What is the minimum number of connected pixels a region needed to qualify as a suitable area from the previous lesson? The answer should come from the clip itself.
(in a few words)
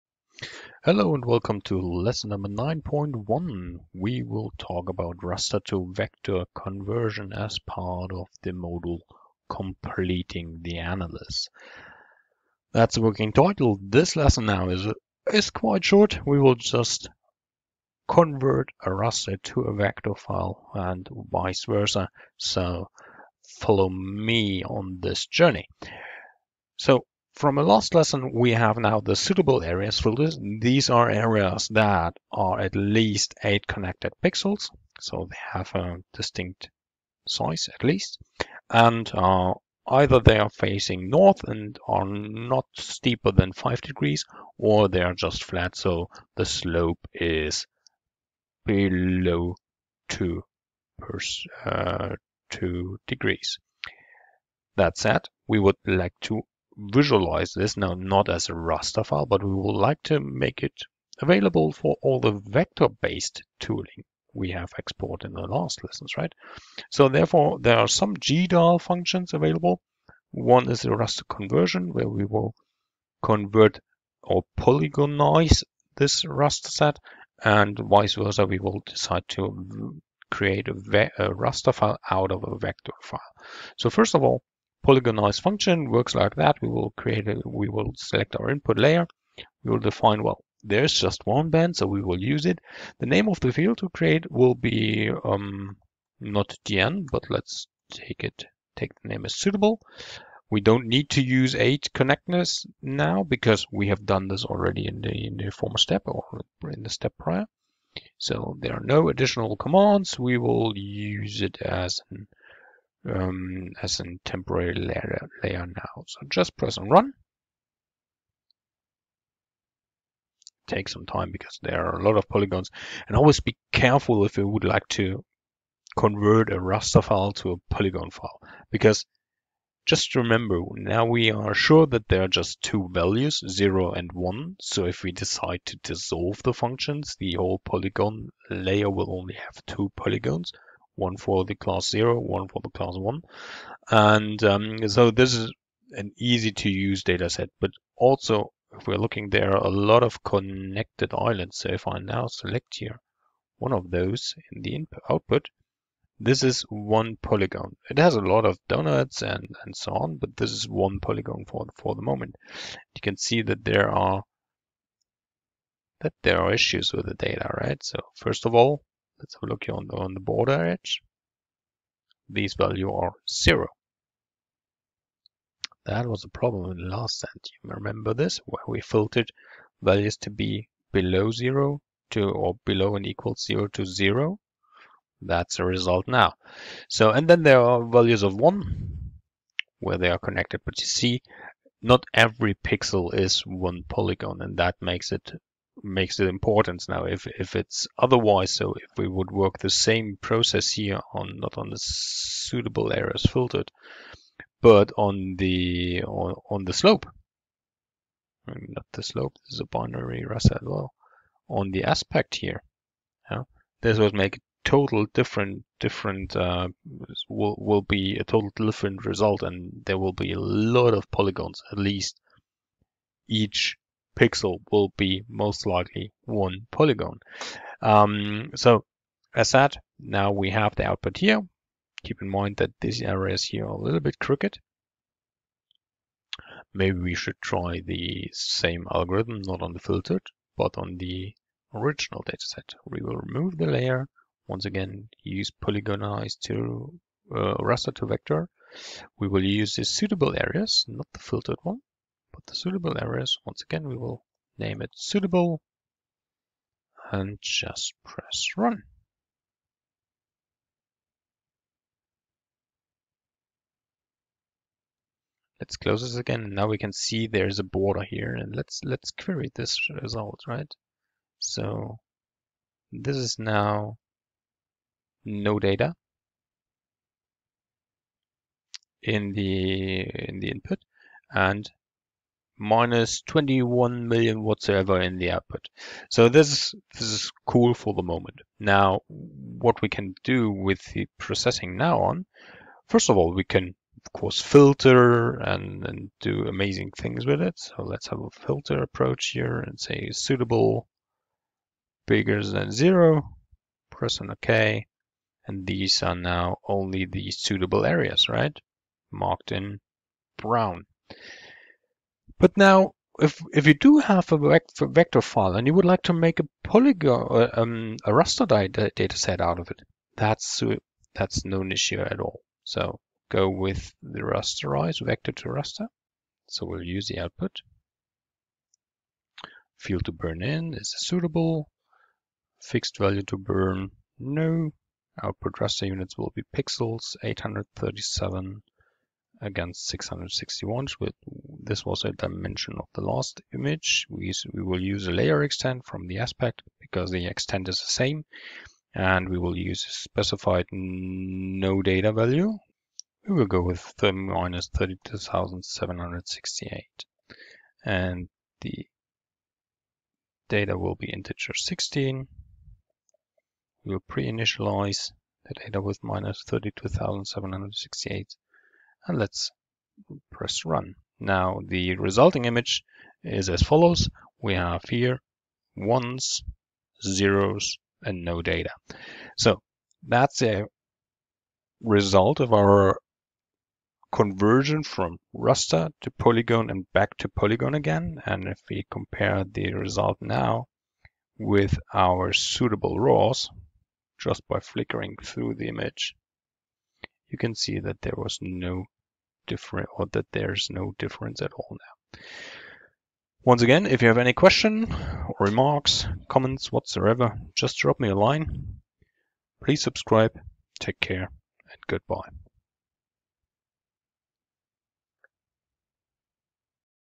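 8.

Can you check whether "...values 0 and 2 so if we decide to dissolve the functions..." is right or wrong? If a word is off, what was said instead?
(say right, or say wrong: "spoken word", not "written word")
wrong: "1", not "2".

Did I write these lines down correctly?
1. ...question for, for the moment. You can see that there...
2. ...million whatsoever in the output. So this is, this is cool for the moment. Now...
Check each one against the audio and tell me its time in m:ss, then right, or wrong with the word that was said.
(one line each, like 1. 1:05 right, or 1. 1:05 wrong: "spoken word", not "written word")
1. 2:41 wrong: "polygon", not "question"
2. 4:44 right.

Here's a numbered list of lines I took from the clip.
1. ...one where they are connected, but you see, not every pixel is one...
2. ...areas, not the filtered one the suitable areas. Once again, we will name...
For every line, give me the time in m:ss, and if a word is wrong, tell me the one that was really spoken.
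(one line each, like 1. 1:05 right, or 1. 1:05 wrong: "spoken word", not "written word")
1. 3:08 right
2. 4:10 right.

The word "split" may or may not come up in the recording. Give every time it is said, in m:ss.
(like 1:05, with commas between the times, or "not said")
not said.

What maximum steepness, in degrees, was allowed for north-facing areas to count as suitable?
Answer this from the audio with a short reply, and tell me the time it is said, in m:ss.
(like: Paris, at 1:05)
5 degrees, at 0:43.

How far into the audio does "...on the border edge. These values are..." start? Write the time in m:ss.
2:49.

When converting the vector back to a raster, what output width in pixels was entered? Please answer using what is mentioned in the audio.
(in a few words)
837.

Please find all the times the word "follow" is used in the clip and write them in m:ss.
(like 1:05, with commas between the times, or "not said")
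0:23, 6:13.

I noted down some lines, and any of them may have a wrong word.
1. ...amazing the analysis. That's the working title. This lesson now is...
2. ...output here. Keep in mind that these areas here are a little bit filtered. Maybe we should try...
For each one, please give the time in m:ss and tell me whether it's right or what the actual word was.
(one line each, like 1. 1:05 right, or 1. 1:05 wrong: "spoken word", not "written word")
1. 0:09 wrong: "completing", not "amazing"
2. 3:50 wrong: "crooked", not "filtered".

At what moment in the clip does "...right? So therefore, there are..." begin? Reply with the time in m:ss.
1:06.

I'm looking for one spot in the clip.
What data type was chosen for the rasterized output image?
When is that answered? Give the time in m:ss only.
6:01.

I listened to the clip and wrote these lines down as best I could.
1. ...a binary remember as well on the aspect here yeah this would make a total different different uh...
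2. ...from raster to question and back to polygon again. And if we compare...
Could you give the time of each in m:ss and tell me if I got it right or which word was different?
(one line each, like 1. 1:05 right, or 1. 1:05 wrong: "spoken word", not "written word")
1. 3:29 wrong: "raster", not "remember"
2. 6:24 wrong: "polygon", not "question".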